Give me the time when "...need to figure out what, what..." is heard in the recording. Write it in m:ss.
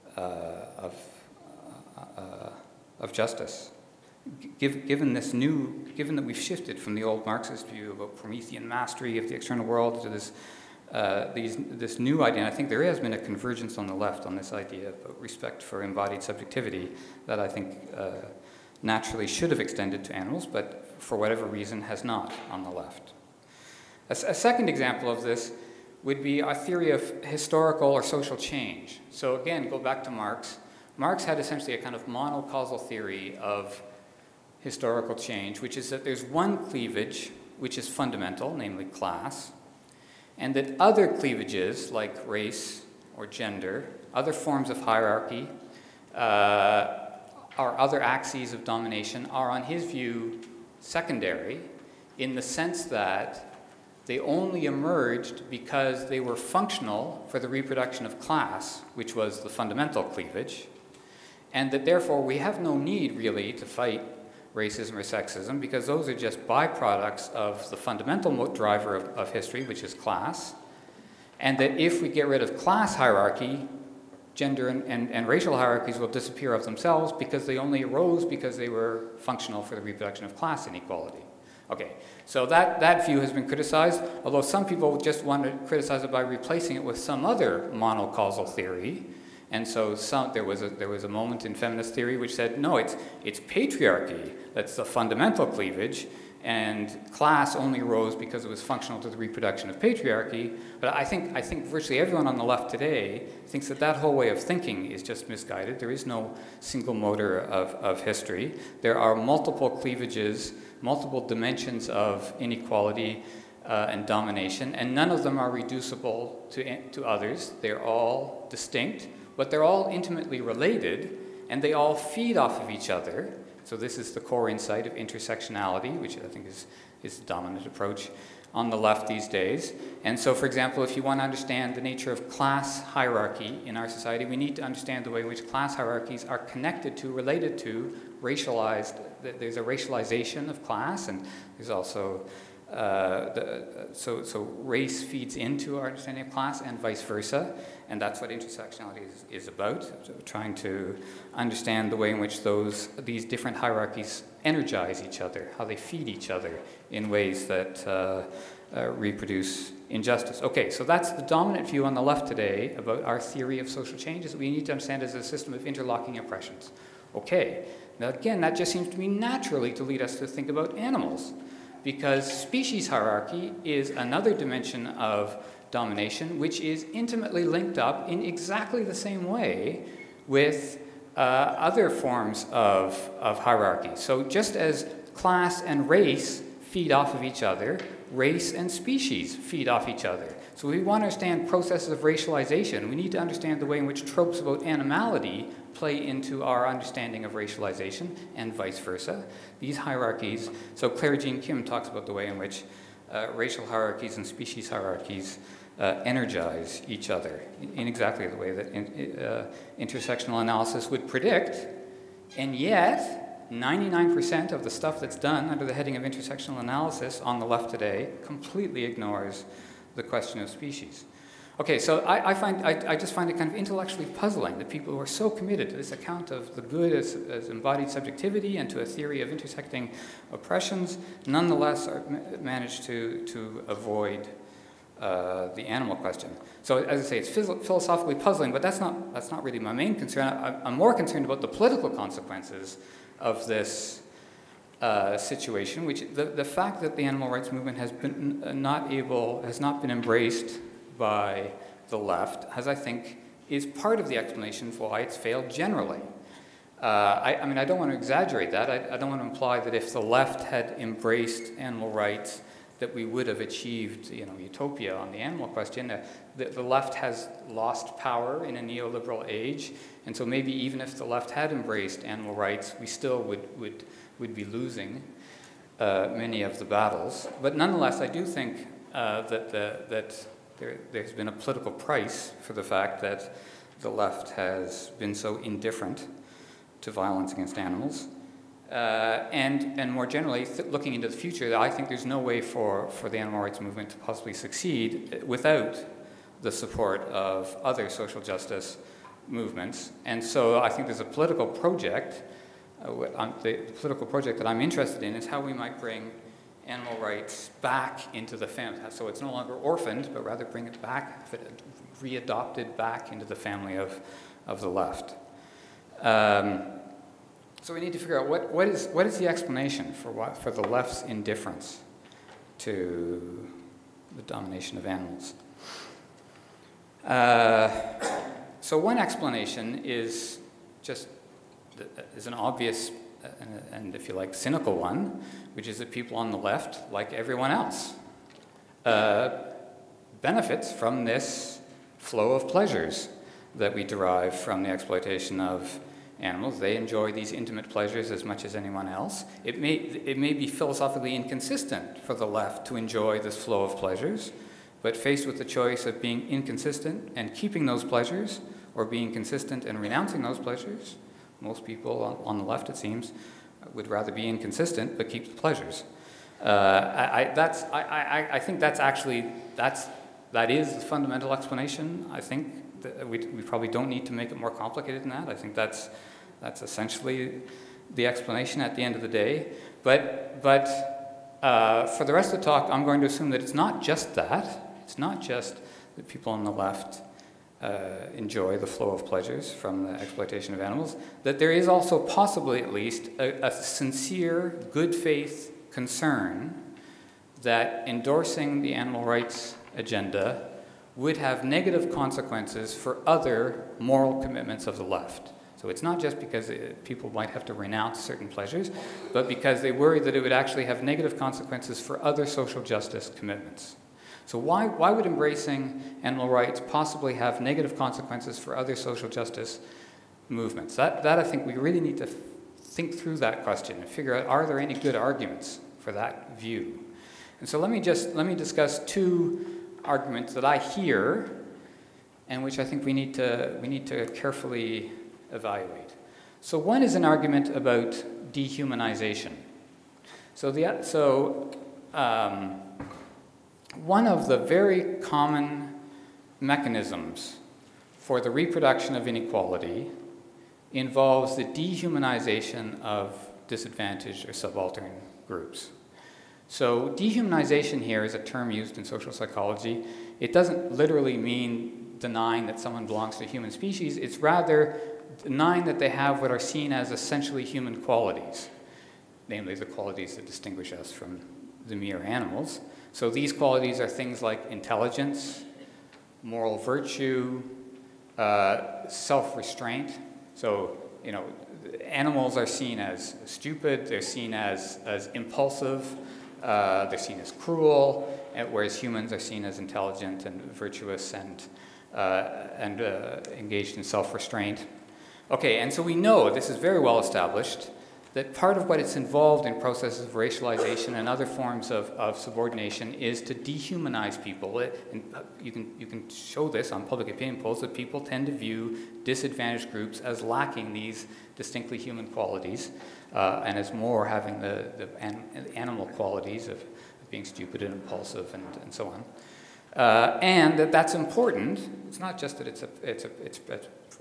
5:17.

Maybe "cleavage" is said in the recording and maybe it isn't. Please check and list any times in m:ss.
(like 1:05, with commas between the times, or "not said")
0:36, 0:41, 1:00, 1:35, 1:49.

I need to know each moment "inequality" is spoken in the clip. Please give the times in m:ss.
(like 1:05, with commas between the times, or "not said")
1:20, 1:52, 7:29.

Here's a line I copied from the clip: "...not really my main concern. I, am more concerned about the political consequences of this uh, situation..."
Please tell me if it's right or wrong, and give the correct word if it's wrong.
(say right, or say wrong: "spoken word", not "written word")
right.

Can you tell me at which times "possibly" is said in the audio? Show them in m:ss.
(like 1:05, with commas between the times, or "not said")
4:53, 6:31, 6:56.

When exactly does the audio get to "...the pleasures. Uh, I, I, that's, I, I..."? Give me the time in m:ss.
6:05.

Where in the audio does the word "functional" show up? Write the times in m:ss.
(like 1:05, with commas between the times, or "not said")
0:56, 1:19, 1:38.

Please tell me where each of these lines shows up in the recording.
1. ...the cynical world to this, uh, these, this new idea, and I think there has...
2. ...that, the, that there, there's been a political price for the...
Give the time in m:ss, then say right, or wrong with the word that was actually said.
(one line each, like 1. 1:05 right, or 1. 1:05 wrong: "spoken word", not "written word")
1. 0:09 wrong: "external", not "cynical"
2. 4:39 right.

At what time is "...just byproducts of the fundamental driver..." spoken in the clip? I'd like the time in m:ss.
1:06.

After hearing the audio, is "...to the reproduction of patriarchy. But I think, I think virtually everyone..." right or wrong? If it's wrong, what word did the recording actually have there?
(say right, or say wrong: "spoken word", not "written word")
right.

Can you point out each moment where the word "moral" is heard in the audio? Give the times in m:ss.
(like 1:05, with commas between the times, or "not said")
6:43, 7:56.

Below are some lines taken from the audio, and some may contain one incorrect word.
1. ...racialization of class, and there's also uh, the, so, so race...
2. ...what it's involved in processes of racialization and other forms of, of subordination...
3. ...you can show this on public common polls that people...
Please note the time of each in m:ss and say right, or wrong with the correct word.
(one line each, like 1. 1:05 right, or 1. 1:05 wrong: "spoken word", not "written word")
1. 2:19 right
2. 8:18 right
3. 8:25 wrong: "opinion", not "common".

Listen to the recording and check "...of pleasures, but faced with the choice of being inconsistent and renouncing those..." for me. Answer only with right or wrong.
wrong.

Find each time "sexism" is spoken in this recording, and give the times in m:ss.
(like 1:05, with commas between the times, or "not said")
1:05.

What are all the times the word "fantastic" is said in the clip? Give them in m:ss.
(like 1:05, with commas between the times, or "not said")
not said.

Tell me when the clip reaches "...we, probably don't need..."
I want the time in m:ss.
6:13.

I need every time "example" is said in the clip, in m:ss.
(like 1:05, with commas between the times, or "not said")
0:24, 2:10.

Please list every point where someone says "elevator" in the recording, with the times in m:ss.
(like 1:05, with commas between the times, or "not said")
not said.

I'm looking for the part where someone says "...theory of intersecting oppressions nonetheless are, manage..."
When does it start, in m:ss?
3:48.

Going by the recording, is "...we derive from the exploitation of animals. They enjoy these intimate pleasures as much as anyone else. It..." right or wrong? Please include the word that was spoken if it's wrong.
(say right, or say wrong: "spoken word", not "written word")
right.